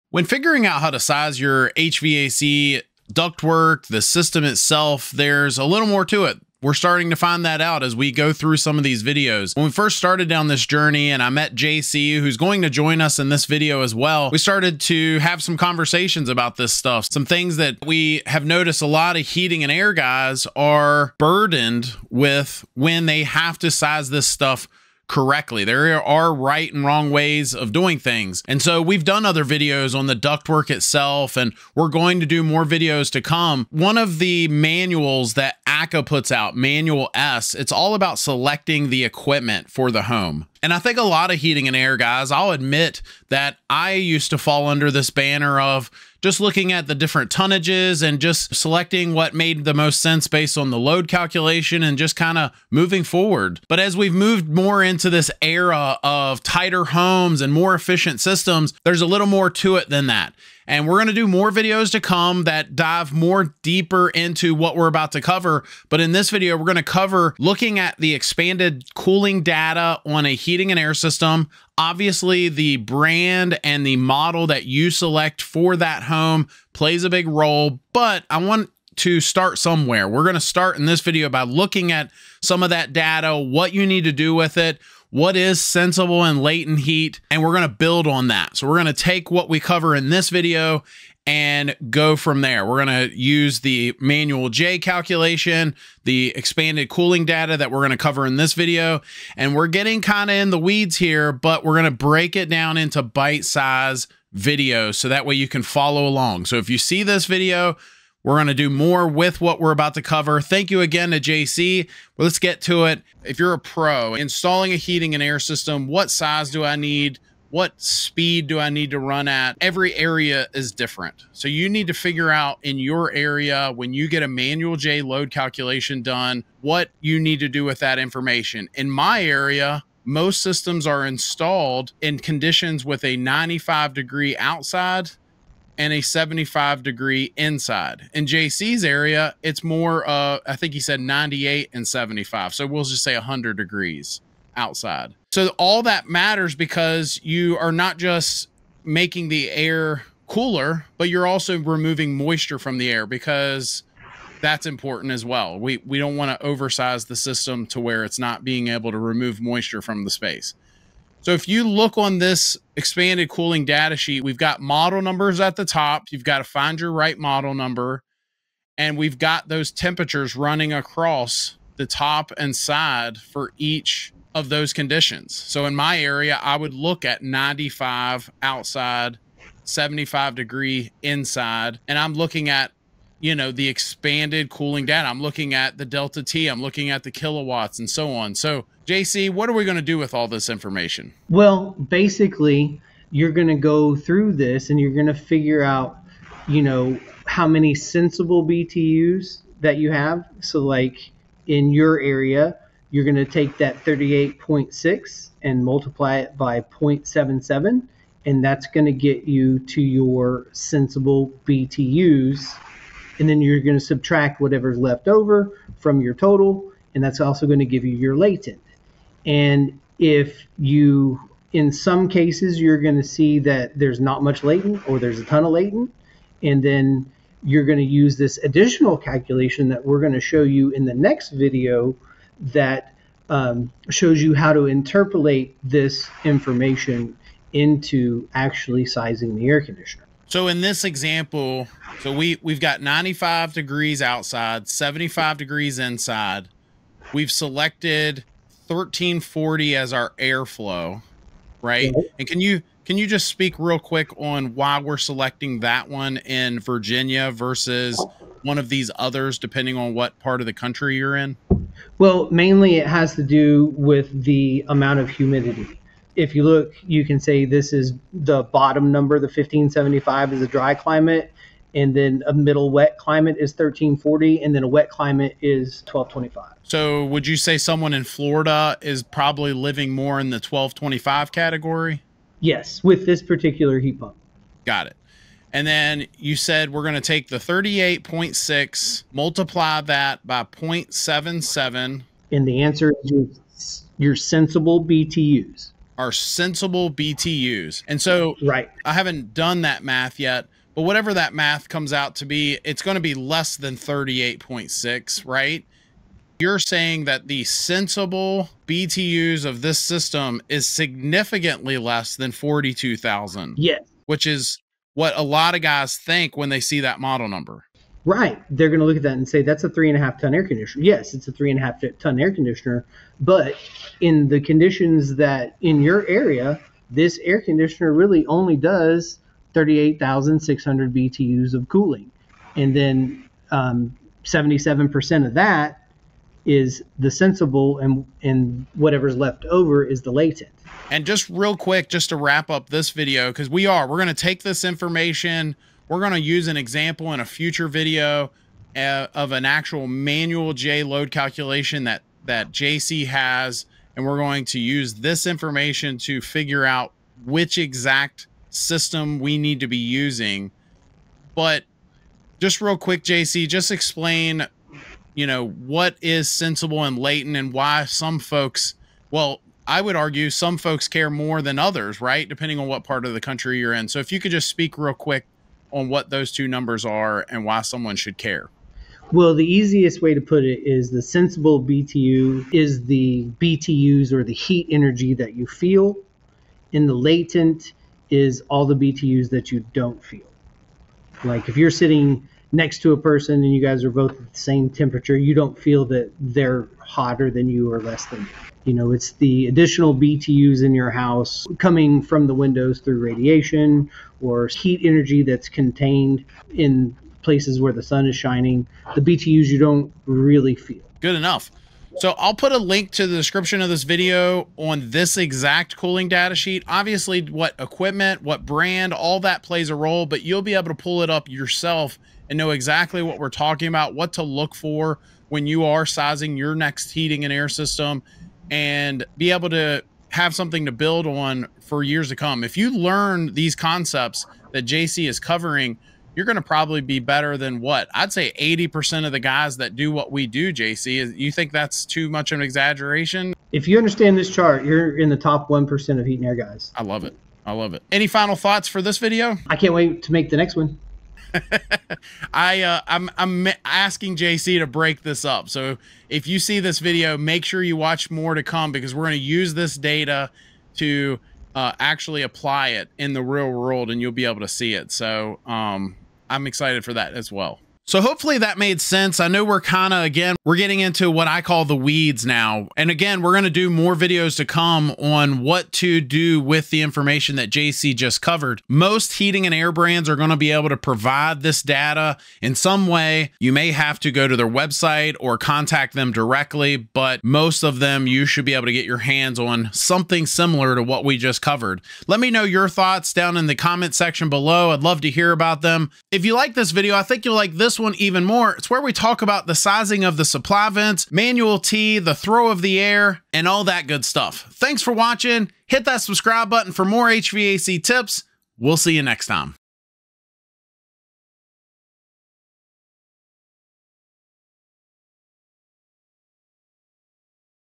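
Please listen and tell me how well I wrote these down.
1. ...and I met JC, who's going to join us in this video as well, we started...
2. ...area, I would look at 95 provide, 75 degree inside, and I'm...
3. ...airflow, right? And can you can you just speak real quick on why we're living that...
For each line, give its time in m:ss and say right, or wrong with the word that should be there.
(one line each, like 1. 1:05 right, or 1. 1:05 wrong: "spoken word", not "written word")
1. 0:11 right
2. 2:55 wrong: "outside", not "provide"
3. 4:10 wrong: "selecting", not "living".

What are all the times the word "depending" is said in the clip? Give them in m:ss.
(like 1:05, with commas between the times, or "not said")
4:19, 6:12.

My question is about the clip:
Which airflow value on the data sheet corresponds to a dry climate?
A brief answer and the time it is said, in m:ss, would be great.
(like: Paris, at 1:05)
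1575, at 4:29.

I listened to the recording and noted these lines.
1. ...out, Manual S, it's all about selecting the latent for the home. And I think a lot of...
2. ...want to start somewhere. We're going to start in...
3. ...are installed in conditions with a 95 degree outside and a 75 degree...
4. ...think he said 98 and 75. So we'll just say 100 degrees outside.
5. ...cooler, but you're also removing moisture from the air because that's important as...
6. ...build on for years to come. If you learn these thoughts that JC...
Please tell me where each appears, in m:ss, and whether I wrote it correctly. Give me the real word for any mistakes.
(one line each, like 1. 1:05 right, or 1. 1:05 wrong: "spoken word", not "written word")
1. 0:36 wrong: "equipment", not "latent"
2. 1:18 right
3. 2:10 right
4. 2:20 right
5. 2:30 right
6. 7:10 wrong: "concepts", not "thoughts".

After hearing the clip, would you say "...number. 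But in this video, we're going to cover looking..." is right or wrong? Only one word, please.
wrong.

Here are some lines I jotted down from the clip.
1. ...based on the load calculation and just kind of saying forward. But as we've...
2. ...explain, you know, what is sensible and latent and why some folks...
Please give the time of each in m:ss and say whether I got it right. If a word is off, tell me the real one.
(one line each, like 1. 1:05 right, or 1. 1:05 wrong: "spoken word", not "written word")
1. 0:50 wrong: "moving", not "saying"
2. 6:03 right.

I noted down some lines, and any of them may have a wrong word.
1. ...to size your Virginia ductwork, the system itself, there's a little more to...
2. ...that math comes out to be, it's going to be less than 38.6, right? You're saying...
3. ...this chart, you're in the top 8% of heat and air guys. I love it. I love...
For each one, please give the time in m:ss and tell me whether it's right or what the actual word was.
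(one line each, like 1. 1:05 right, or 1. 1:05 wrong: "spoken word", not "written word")
1. 0:00 wrong: "HVAC", not "Virginia"
2. 5:01 right
3. 7:24 wrong: "1", not "8".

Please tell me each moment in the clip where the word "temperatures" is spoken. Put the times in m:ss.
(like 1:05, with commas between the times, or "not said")
2:49, 6:34.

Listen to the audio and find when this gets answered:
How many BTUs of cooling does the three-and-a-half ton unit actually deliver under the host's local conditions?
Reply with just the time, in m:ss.
5:29.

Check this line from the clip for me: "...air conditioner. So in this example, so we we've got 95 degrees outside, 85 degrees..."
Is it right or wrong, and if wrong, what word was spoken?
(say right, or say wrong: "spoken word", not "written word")
wrong: "75", not "85".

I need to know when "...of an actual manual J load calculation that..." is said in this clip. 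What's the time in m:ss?
5:49.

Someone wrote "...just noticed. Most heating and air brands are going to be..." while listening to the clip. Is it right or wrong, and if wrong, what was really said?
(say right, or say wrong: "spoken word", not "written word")
wrong: "covered", not "noticed".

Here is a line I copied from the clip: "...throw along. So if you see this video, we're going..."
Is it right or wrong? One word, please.
wrong.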